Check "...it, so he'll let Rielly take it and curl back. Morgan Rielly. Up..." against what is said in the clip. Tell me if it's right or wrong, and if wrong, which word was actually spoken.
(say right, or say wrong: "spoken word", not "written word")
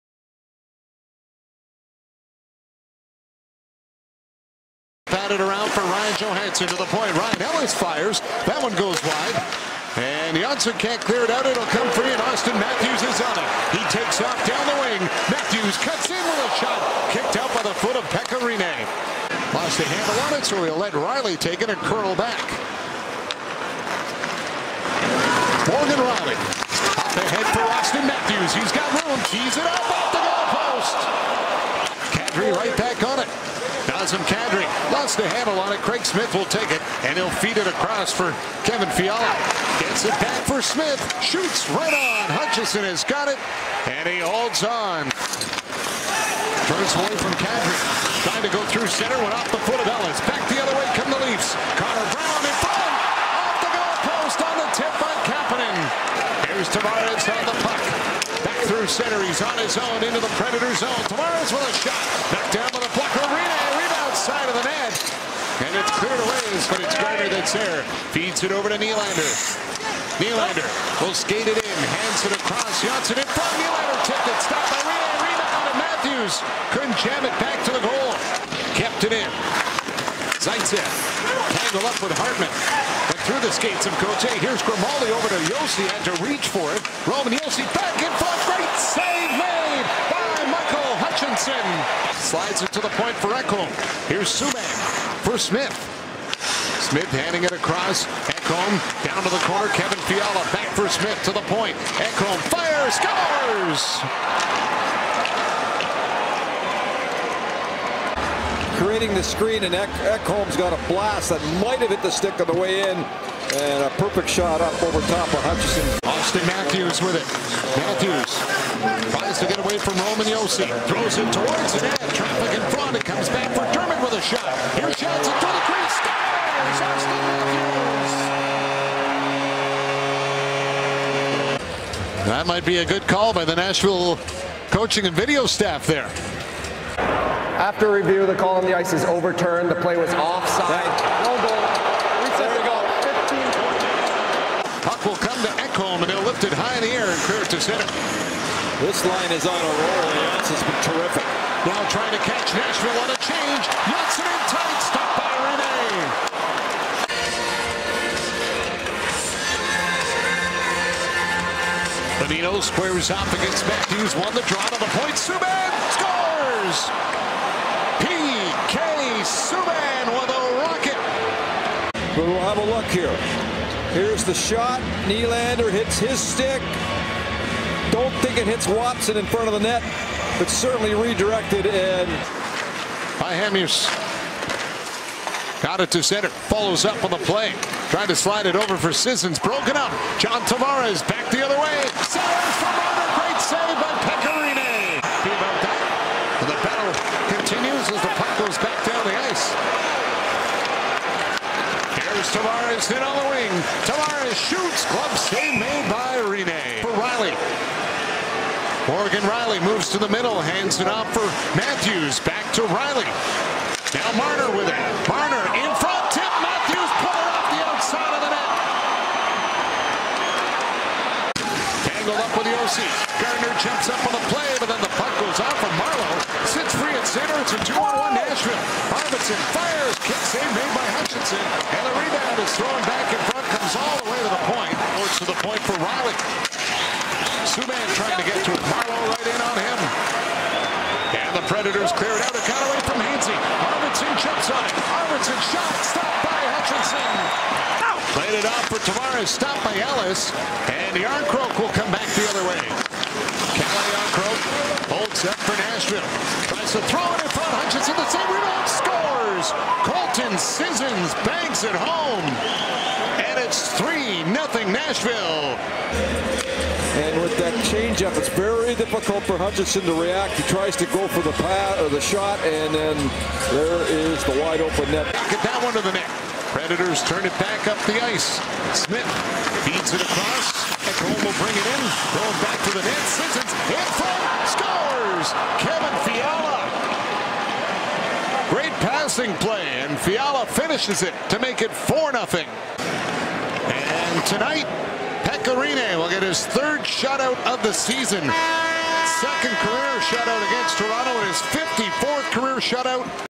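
right.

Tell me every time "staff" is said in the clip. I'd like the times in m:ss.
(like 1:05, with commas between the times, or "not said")
2:15.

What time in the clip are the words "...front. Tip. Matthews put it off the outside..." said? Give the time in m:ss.
3:35.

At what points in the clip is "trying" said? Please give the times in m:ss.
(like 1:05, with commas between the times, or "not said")
0:48, 2:31, 3:07, 3:57.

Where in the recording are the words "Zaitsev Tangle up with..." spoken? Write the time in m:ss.
1:20.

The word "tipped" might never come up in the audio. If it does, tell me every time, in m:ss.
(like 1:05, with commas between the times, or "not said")
1:14.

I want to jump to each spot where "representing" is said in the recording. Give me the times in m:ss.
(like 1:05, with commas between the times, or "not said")
not said.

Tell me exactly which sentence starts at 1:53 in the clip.
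And a perfect shot up over top of Hutchinson.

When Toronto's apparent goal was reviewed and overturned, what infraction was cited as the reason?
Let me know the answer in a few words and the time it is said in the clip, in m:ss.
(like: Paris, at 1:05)
Offside, at 2:19.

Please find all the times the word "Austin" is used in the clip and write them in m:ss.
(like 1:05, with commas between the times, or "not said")
0:12, 0:27, 1:56, 2:06.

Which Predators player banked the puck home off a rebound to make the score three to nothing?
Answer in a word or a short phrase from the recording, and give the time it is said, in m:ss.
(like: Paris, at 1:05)
Colton Sissons, at 4:19.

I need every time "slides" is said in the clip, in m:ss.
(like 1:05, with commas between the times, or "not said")
1:32, 3:08.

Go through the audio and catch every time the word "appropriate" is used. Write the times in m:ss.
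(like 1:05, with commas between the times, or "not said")
not said.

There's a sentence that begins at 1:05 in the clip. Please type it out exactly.
And it's cleared away But it's Gardiner that's there.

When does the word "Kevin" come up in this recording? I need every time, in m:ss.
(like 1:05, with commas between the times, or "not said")
0:38, 1:39, 4:45.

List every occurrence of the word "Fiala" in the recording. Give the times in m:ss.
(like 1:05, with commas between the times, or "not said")
0:38, 1:40, 4:45, 4:49.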